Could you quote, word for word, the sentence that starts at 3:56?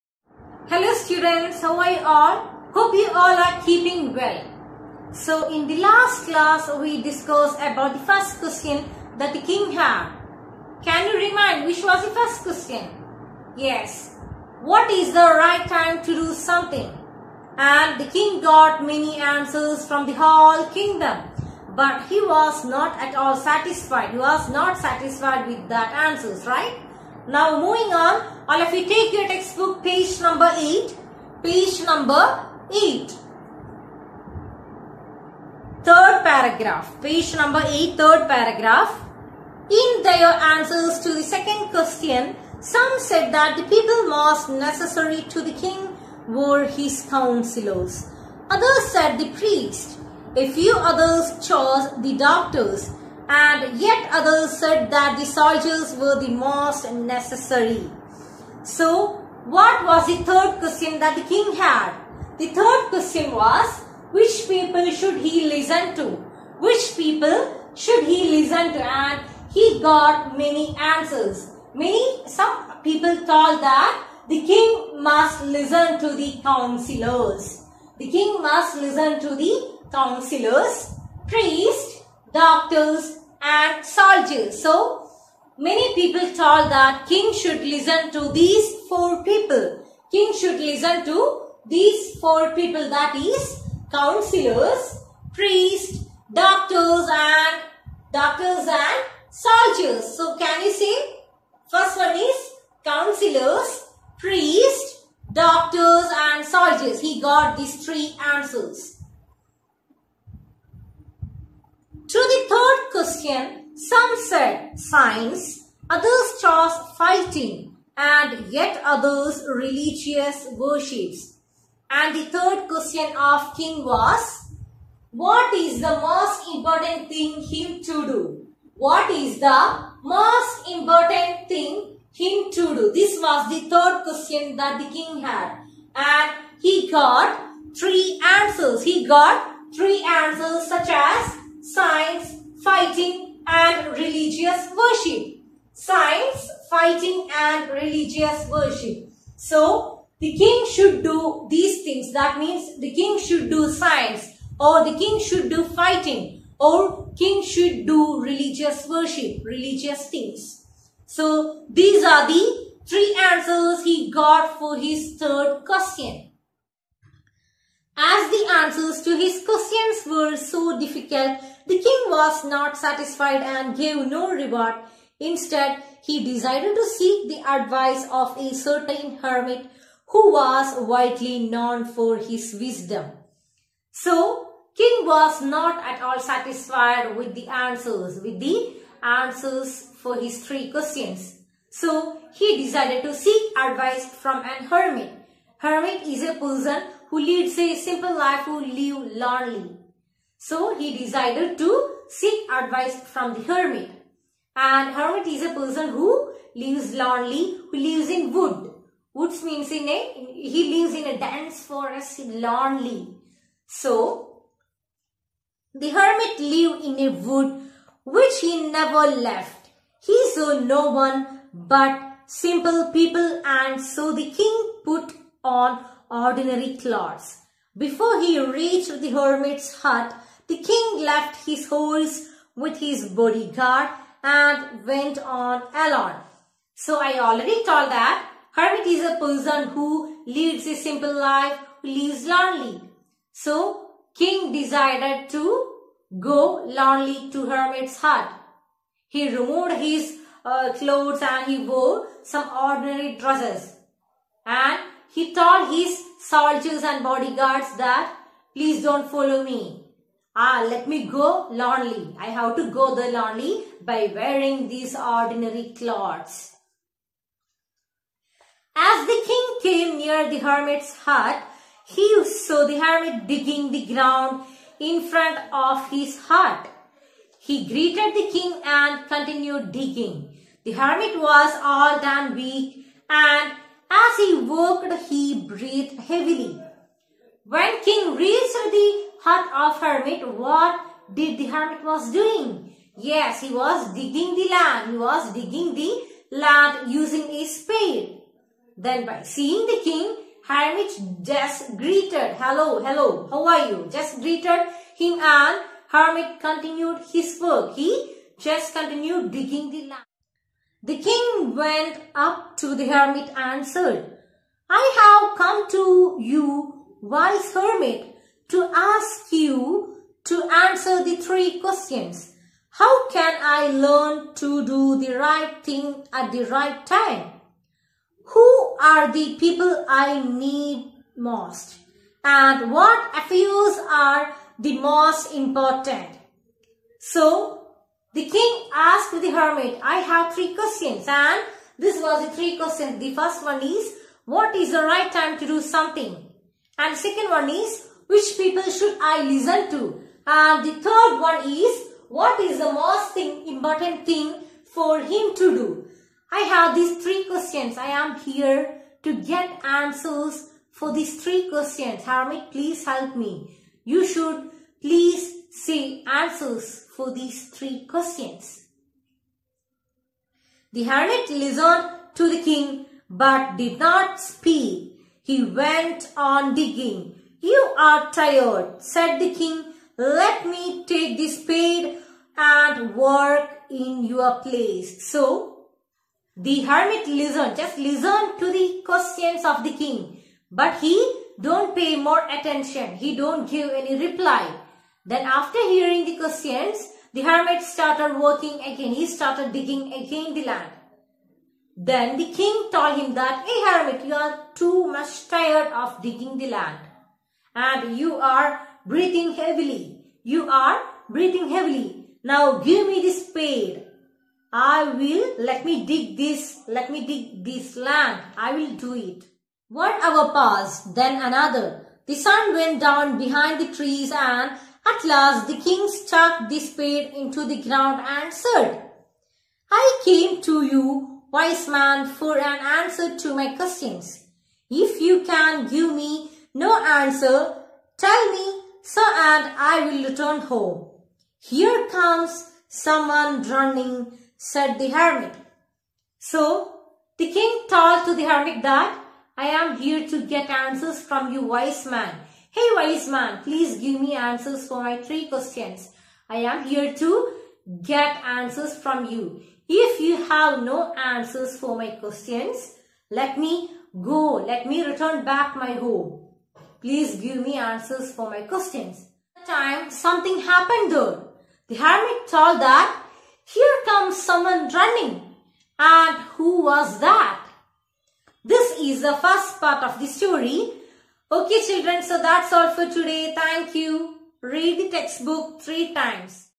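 So I already told that hermit is a person who leads a simple life, who lives lonely.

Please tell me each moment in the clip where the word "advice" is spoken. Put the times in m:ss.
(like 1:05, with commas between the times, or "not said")
2:57, 3:13, 3:22.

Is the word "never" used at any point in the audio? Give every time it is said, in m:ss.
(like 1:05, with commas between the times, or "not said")
3:38.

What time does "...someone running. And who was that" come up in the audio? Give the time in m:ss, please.
7:54.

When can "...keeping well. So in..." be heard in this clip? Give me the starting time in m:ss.
0:03.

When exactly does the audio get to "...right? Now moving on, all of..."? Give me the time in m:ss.
0:26.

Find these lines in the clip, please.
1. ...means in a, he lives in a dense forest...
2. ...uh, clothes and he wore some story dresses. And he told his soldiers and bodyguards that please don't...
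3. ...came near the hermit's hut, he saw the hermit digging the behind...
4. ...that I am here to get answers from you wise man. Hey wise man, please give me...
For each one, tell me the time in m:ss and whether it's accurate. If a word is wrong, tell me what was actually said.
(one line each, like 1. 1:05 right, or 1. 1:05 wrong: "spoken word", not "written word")
1. 3:29 right
2. 4:10 wrong: "ordinary", not "story"
3. 4:29 wrong: "ground", not "behind"
4. 7:28 right.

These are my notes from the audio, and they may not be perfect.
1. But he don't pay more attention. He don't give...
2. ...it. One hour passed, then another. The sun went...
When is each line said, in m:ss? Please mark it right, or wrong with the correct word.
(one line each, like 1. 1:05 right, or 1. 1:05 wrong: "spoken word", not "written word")
1. 6:30 right
2. 6:58 right.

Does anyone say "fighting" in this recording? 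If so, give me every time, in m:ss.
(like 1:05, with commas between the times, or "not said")
1:56, 2:22, 2:26, 2:35.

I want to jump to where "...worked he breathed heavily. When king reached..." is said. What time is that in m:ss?
4:44.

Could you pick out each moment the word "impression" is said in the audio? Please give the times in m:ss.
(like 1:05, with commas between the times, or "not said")
not said.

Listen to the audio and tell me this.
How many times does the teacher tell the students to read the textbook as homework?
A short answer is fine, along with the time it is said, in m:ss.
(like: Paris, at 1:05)
3, at 8:05.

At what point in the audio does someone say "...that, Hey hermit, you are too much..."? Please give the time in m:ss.
6:43.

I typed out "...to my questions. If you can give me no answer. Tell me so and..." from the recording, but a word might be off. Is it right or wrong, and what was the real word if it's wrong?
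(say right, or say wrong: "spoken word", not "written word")
right.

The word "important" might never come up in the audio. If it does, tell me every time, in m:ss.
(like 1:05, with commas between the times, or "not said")
2:06, 2:10, 5:35, 5:53.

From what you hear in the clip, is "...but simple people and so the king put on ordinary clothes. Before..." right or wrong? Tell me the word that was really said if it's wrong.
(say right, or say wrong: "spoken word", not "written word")
right.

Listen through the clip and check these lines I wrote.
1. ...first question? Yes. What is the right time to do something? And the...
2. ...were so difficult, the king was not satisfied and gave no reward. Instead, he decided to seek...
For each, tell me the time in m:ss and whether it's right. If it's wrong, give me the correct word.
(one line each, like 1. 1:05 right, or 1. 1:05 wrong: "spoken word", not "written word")
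1. 0:12 right
2. 2:50 right.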